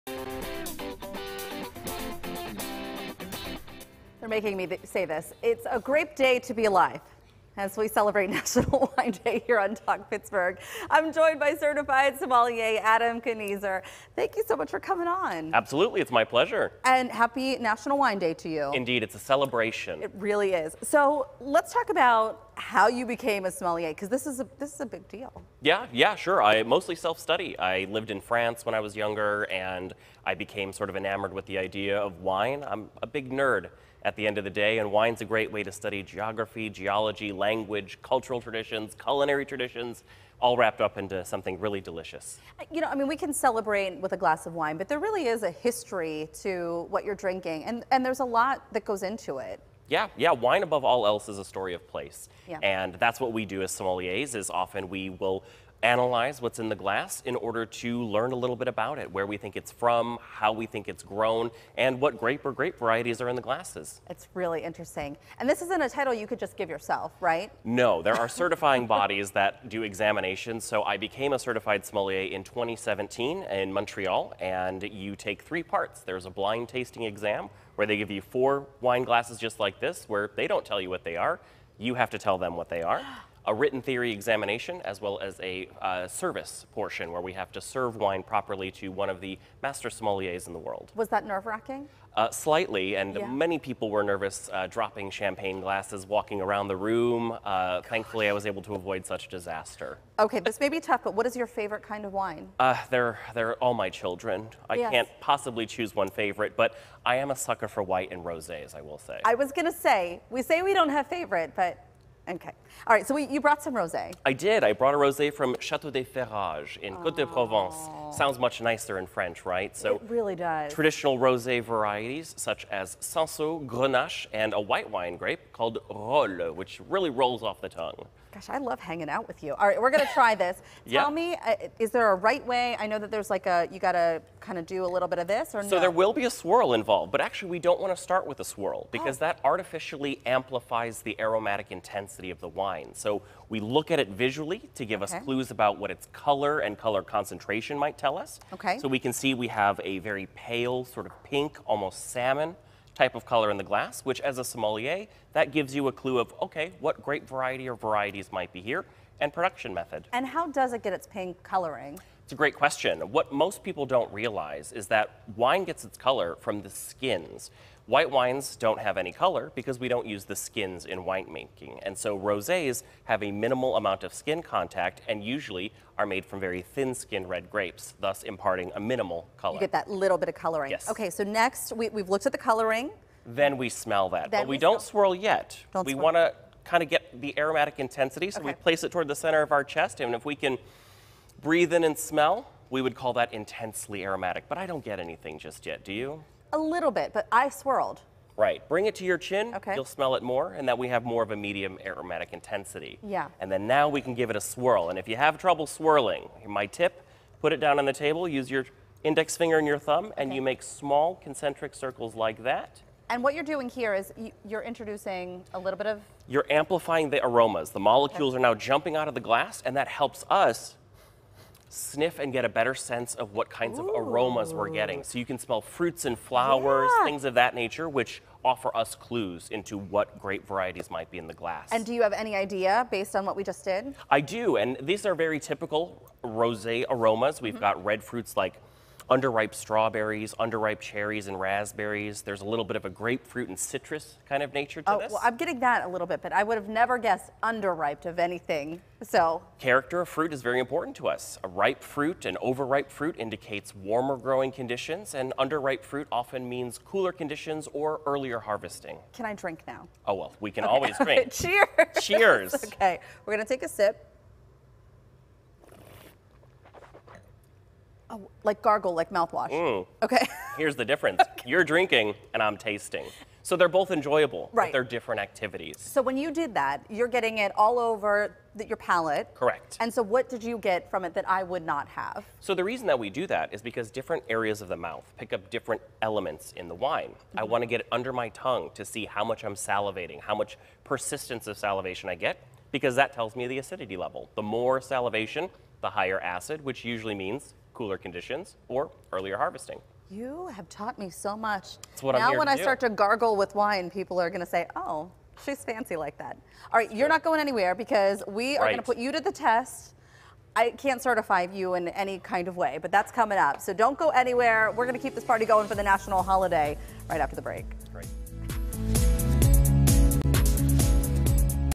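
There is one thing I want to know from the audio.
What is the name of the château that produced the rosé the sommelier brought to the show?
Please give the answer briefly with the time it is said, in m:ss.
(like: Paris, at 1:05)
Chateau des Ferrages, at 1:55.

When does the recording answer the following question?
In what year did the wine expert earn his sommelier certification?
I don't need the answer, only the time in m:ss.
1:12.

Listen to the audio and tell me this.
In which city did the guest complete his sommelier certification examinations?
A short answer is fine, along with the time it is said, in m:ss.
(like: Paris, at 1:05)
Montreal, at 1:13.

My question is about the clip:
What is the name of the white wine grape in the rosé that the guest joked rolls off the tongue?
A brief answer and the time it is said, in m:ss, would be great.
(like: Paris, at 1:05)
Rolle, at 2:05.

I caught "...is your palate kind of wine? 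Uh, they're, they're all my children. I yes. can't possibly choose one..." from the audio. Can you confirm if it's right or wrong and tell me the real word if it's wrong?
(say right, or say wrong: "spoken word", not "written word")
wrong: "favorite", not "palate".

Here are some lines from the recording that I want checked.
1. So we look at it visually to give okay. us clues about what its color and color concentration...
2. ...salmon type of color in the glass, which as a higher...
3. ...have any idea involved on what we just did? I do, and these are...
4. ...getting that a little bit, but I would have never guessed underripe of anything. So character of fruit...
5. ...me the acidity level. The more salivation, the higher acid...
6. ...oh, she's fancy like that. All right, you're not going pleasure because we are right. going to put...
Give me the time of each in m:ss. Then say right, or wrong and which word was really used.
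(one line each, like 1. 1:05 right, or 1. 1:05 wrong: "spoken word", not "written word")
1. 2:22 right
2. 2:32 wrong: "sommelier", not "higher"
3. 3:52 wrong: "based", not "involved"
4. 4:05 right
5. 4:53 right
6. 5:04 wrong: "anywhere", not "pleasure".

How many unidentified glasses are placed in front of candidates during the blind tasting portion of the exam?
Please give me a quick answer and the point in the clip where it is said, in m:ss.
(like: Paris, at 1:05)
4, at 1:18.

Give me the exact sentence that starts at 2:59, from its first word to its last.
You get that little bit of coloring.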